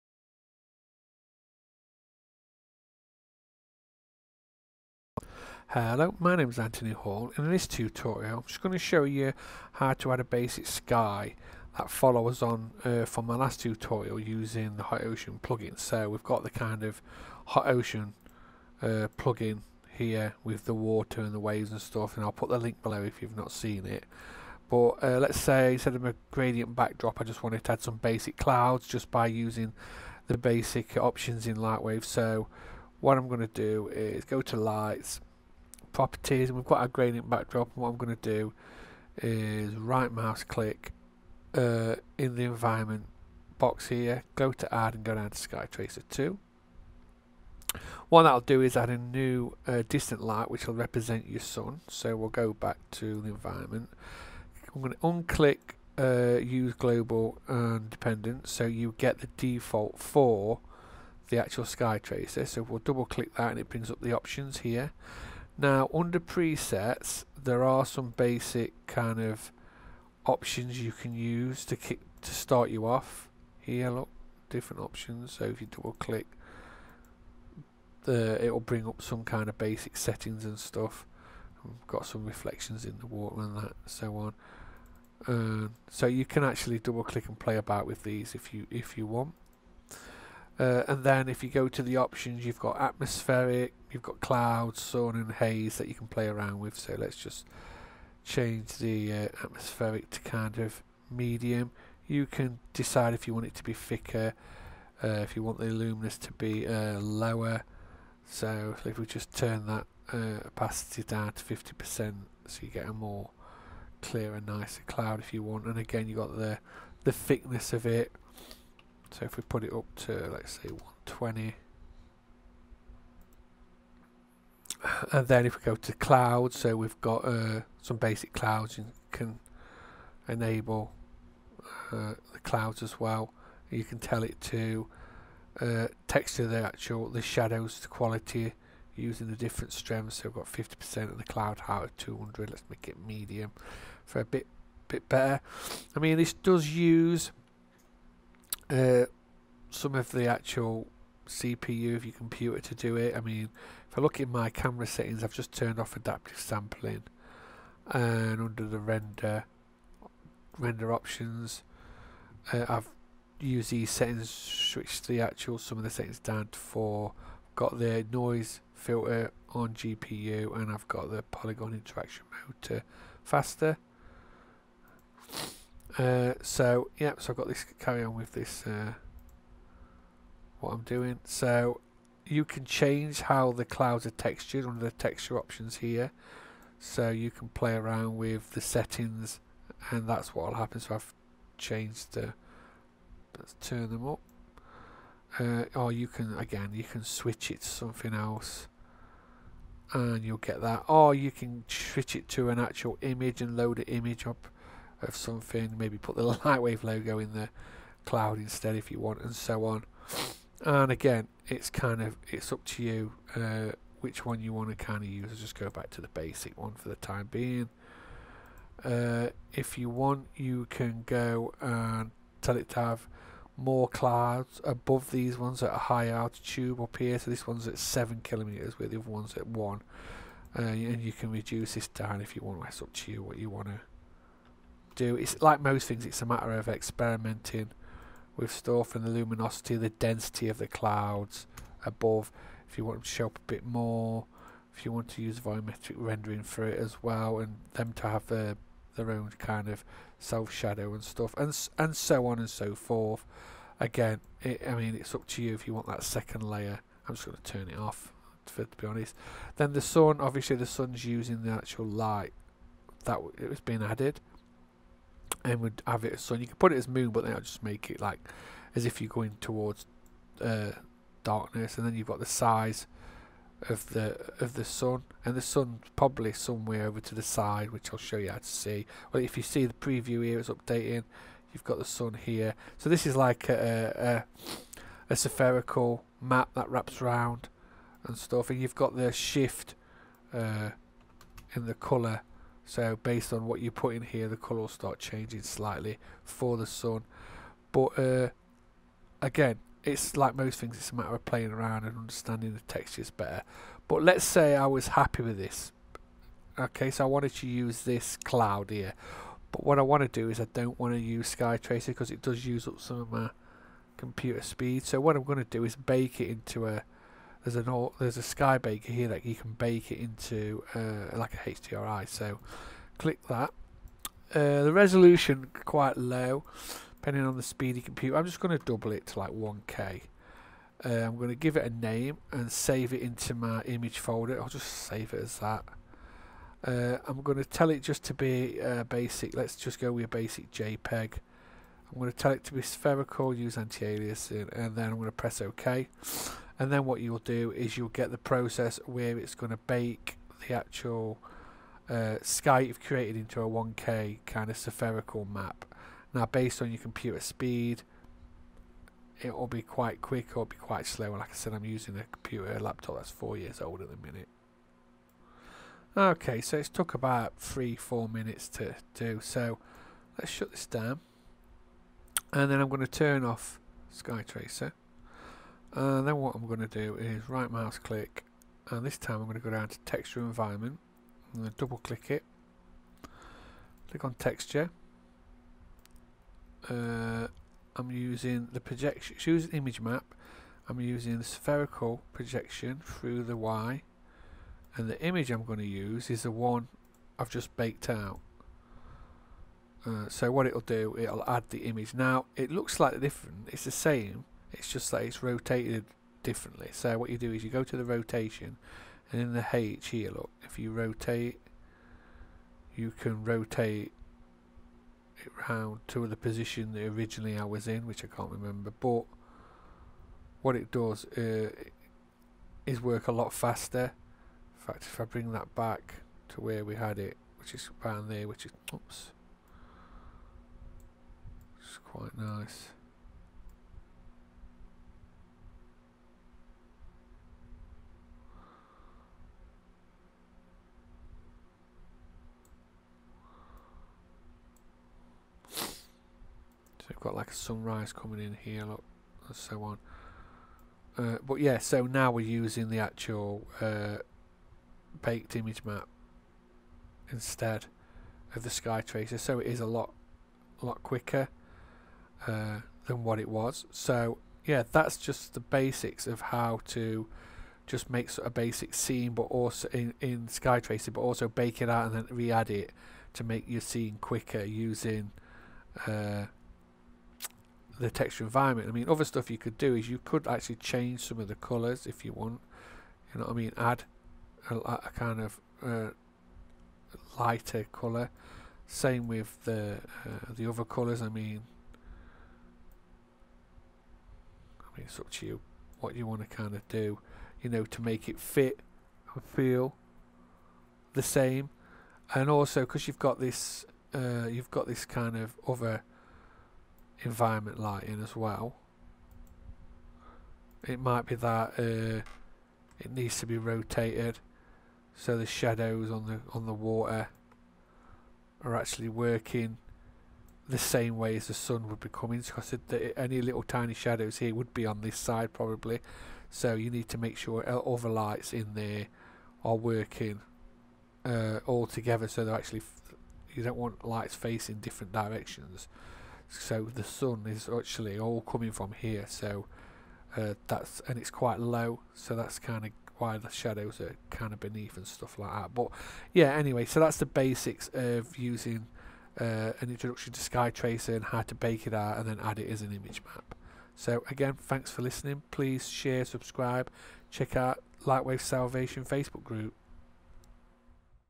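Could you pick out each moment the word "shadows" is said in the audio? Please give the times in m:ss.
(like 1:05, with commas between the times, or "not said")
2:17, 4:10, 8:35, 8:43, 9:03.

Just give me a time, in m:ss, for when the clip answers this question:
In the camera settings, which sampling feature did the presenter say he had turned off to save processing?
2:35.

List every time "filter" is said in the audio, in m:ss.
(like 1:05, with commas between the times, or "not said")
2:48.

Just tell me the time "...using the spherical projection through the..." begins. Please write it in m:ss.
6:30.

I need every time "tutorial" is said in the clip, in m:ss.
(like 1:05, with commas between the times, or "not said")
0:07, 0:13.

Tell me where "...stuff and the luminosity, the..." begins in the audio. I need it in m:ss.
3:58.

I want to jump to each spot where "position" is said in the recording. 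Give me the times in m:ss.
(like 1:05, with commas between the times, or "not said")
6:56.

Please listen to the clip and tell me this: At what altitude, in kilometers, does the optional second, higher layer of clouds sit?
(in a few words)
7 kilometers.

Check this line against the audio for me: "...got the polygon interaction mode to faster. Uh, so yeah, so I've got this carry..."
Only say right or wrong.
right.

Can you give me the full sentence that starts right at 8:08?
Same with the uh, the other colors.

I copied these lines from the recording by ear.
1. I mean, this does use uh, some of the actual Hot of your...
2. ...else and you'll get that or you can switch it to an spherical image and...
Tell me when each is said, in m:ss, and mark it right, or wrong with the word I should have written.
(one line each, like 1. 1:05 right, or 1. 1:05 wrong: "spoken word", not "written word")
1. 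2:25 wrong: "CPU", not "Hot"
2. 3:18 wrong: "actual", not "spherical".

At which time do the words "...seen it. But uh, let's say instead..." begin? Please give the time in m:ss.
0:23.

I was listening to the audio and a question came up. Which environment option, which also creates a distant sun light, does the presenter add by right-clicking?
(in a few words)
Sky Tracer 2.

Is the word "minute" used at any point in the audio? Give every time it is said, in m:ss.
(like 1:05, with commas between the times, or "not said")
6:03, 6:08.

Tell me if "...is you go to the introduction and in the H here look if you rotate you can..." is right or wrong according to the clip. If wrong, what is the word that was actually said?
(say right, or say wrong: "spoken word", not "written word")
wrong: "rotation", not "introduction".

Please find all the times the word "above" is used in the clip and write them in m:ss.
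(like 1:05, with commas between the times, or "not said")
3:44, 4:01.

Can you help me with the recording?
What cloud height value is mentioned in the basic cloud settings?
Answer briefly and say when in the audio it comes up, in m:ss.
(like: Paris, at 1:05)
200, at 2:21.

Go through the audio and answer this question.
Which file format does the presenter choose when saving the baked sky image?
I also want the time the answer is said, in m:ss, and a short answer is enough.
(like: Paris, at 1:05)
JPEG, at 5:40.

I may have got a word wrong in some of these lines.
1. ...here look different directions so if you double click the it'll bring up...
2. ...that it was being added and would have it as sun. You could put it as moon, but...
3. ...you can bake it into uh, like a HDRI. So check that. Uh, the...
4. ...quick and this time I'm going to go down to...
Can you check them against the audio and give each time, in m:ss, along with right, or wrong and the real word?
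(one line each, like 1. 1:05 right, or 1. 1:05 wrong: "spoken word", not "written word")
1. 1:13 wrong: "options", not "directions"
2. 4:23 right
3. 5:19 wrong: "click", not "check"
4. 6:17 wrong: "click", not "quick".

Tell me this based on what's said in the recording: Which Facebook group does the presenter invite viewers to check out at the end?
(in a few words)
Lightwave Salvation.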